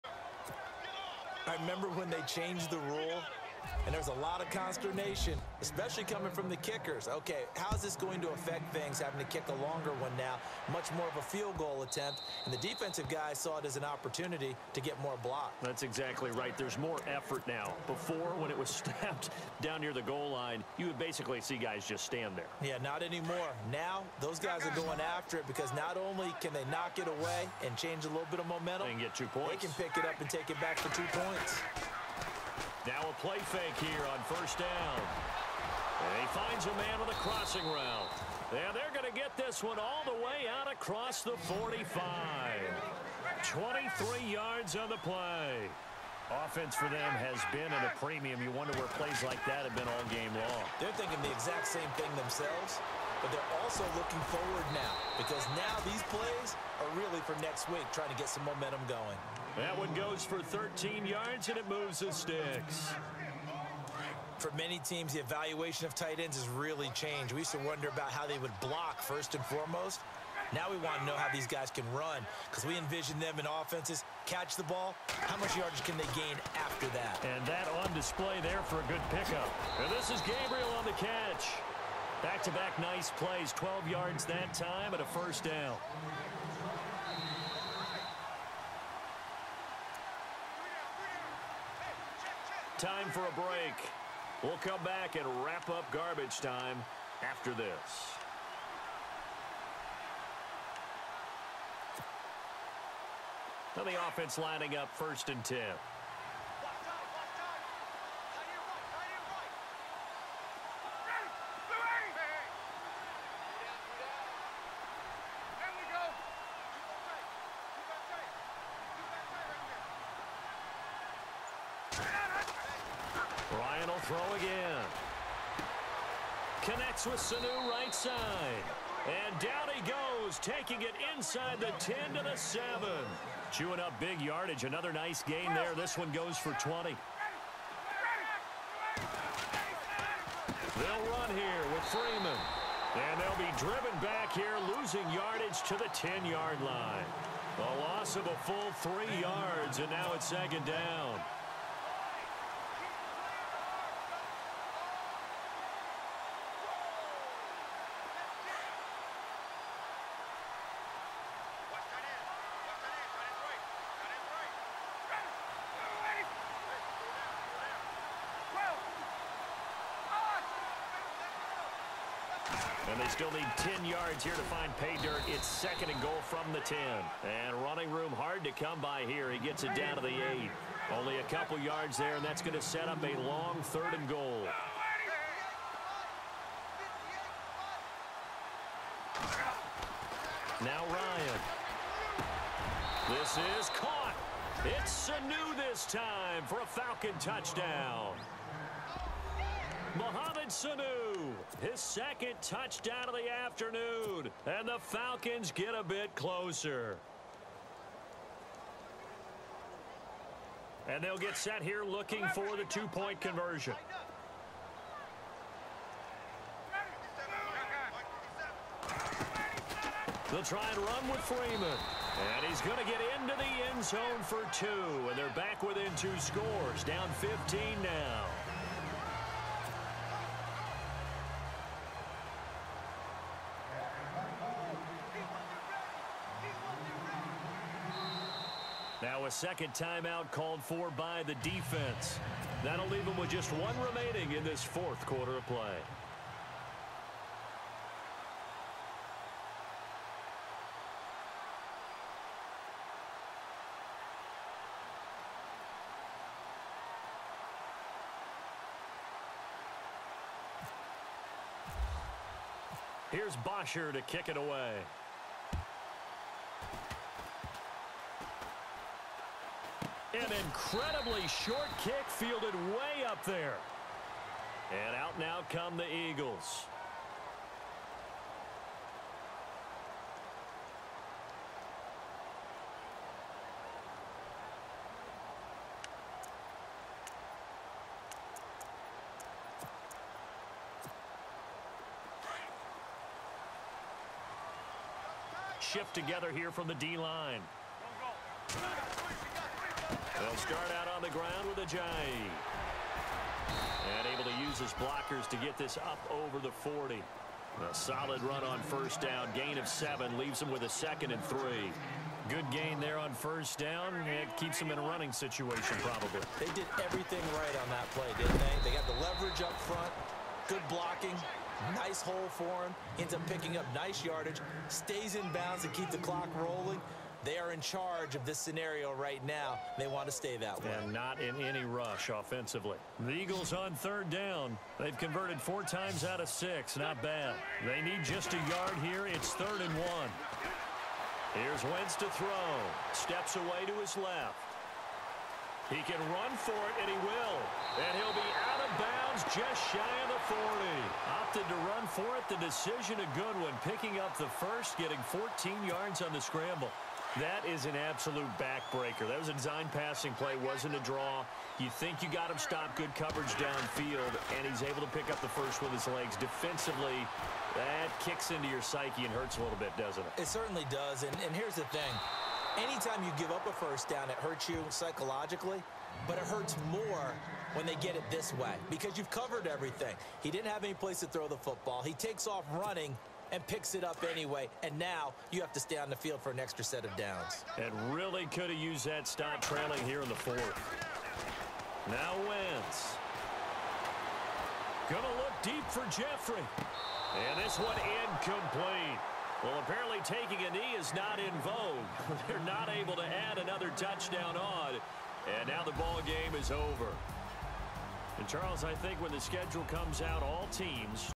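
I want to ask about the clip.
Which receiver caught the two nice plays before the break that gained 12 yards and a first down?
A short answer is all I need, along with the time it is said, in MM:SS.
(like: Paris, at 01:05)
Gabriel, at 01:20.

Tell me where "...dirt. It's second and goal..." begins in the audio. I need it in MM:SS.
02:55.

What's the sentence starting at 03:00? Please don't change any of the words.
Only a couple yards there, and that's going to set up a long third and goal.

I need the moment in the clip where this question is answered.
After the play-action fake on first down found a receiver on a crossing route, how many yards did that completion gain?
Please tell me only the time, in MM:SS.
00:41.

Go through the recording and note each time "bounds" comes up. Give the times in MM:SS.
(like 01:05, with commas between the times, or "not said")
05:25, 05:48.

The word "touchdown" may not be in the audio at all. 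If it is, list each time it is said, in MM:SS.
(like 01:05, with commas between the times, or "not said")
03:17, 03:22, 06:43.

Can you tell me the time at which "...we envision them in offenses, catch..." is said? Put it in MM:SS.
01:12.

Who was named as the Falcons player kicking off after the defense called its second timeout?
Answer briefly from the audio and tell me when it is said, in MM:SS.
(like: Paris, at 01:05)
Bosher, at 04:23.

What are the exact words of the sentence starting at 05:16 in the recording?
They did everything right on that play, didn't they?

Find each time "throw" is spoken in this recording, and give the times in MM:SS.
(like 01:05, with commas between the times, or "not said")
02:04, 05:42, 06:21.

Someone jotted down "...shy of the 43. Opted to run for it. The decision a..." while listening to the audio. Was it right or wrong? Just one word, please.
wrong.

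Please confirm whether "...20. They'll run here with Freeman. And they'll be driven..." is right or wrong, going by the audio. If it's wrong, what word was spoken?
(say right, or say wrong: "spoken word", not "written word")
right.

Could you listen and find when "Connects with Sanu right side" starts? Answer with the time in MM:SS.
02:06.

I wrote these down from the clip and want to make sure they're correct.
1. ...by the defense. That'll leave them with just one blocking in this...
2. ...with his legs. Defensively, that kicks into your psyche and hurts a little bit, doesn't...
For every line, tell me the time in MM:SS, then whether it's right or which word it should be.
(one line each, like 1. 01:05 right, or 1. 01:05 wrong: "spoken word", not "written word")
1. 04:00 wrong: "remaining", not "blocking"
2. 06:05 right.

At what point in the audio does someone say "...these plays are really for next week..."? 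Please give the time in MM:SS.
00:55.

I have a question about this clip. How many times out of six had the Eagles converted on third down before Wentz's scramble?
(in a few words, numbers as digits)
4.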